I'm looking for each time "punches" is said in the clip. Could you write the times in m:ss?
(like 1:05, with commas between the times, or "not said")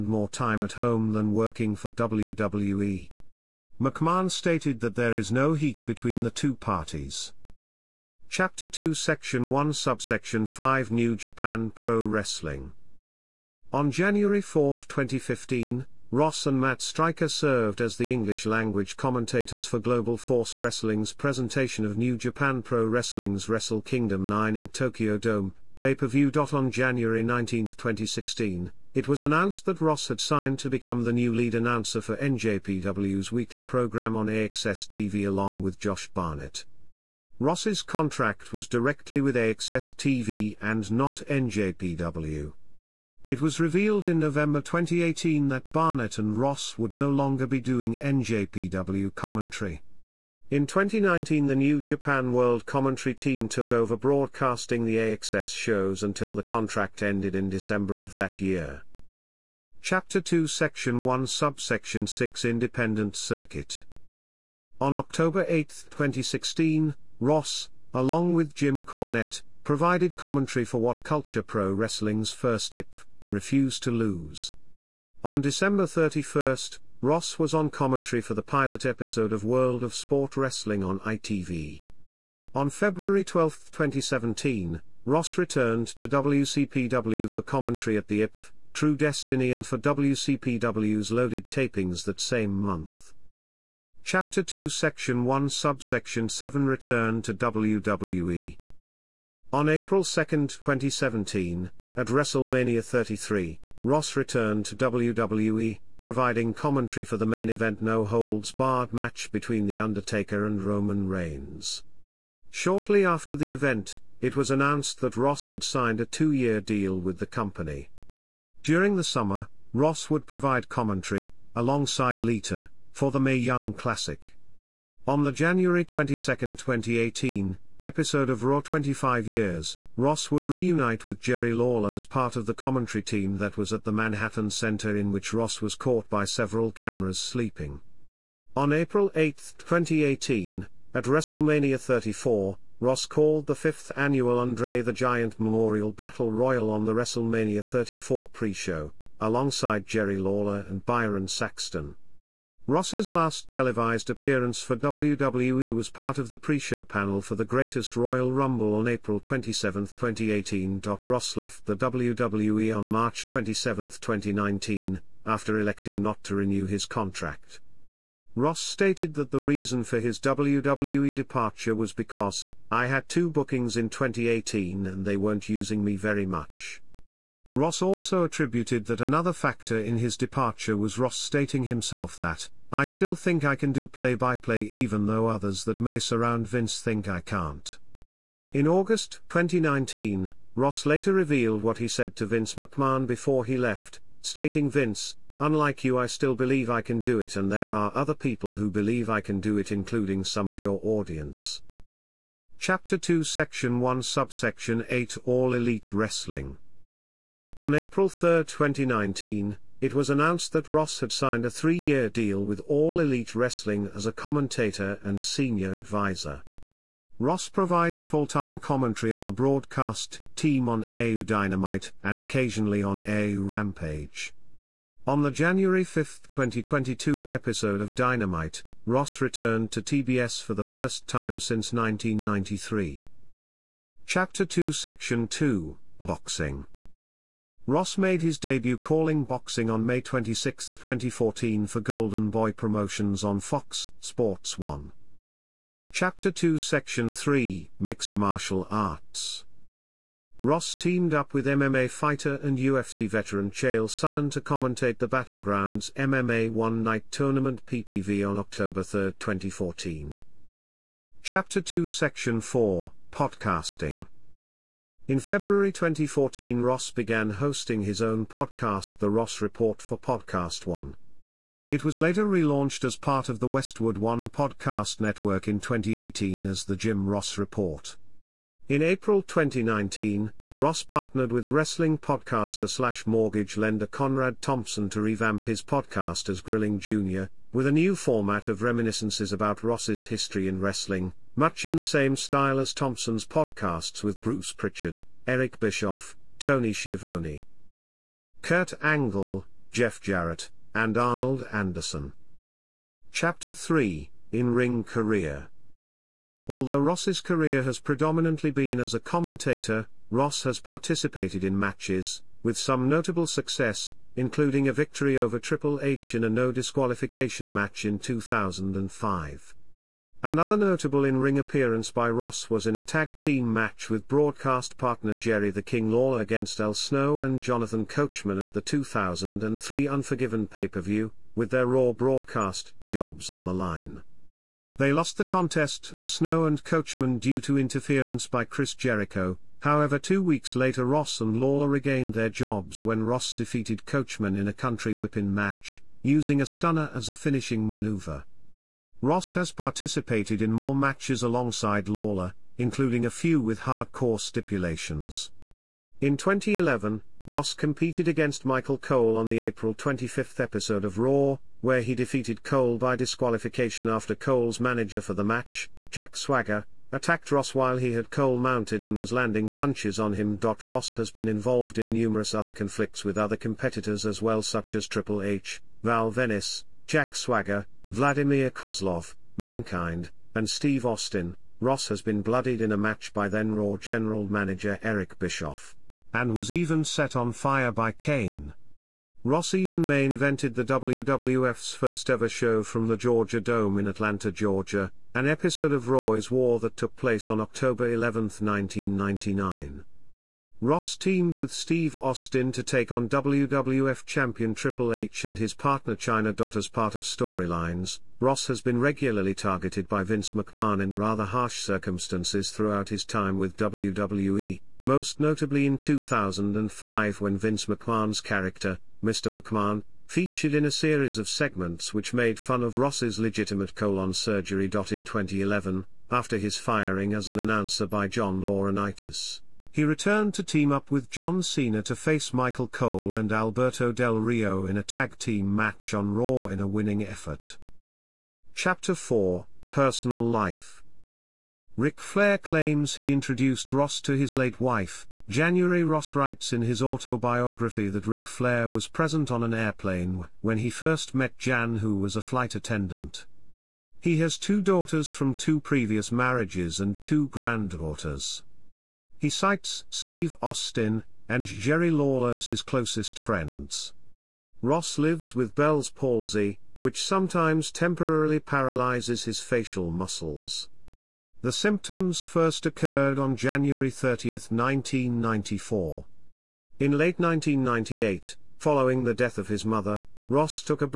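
6:09.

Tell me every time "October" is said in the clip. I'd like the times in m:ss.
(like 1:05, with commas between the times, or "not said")
1:04, 4:18, 6:37.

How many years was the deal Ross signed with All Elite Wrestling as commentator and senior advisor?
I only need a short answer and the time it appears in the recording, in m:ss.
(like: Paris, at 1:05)
3, at 3:31.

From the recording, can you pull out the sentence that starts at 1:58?
During the summer, Ross would provide commentary, alongside Lita, for the Mae Young Classic.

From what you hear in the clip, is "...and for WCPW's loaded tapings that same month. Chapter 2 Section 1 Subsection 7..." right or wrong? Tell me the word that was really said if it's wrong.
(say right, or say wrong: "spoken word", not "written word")
right.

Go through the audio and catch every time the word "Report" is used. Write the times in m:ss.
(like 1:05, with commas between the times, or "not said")
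4:29, 4:37.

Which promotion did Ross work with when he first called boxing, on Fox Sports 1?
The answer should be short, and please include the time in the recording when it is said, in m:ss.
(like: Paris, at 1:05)
Golden Boy Promotions, at 4:01.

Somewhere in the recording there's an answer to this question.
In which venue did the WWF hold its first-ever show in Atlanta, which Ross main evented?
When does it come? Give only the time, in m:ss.
6:32.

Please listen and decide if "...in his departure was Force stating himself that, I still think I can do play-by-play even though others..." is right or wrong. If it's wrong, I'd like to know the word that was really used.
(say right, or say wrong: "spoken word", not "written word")
wrong: "Ross", not "Force".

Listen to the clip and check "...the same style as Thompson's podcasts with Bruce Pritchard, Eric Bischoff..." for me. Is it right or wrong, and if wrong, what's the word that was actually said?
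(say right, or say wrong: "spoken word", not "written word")
right.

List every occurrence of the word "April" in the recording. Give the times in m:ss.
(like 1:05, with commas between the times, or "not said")
1:39, 2:18, 2:38, 3:27, 4:38, 5:59.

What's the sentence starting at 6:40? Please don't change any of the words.
Ross teamed with Steve Austin to take on WWF Champion Triple H and his partner Chyna Dot as part of storylines.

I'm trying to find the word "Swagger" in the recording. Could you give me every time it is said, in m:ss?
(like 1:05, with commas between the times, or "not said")
6:06, 6:17.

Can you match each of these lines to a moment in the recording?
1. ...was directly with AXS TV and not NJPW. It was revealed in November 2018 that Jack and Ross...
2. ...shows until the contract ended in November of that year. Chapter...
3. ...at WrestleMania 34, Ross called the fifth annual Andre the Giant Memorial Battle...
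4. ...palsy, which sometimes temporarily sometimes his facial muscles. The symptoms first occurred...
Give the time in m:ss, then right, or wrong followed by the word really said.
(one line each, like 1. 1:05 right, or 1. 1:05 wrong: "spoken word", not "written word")
1. 0:38 wrong: "Barnett", not "Jack"
2. 0:55 wrong: "December", not "November"
3. 2:20 right
4. 7:45 wrong: "paralyzes", not "sometimes".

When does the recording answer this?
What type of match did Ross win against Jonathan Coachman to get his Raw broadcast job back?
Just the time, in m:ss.
5:44.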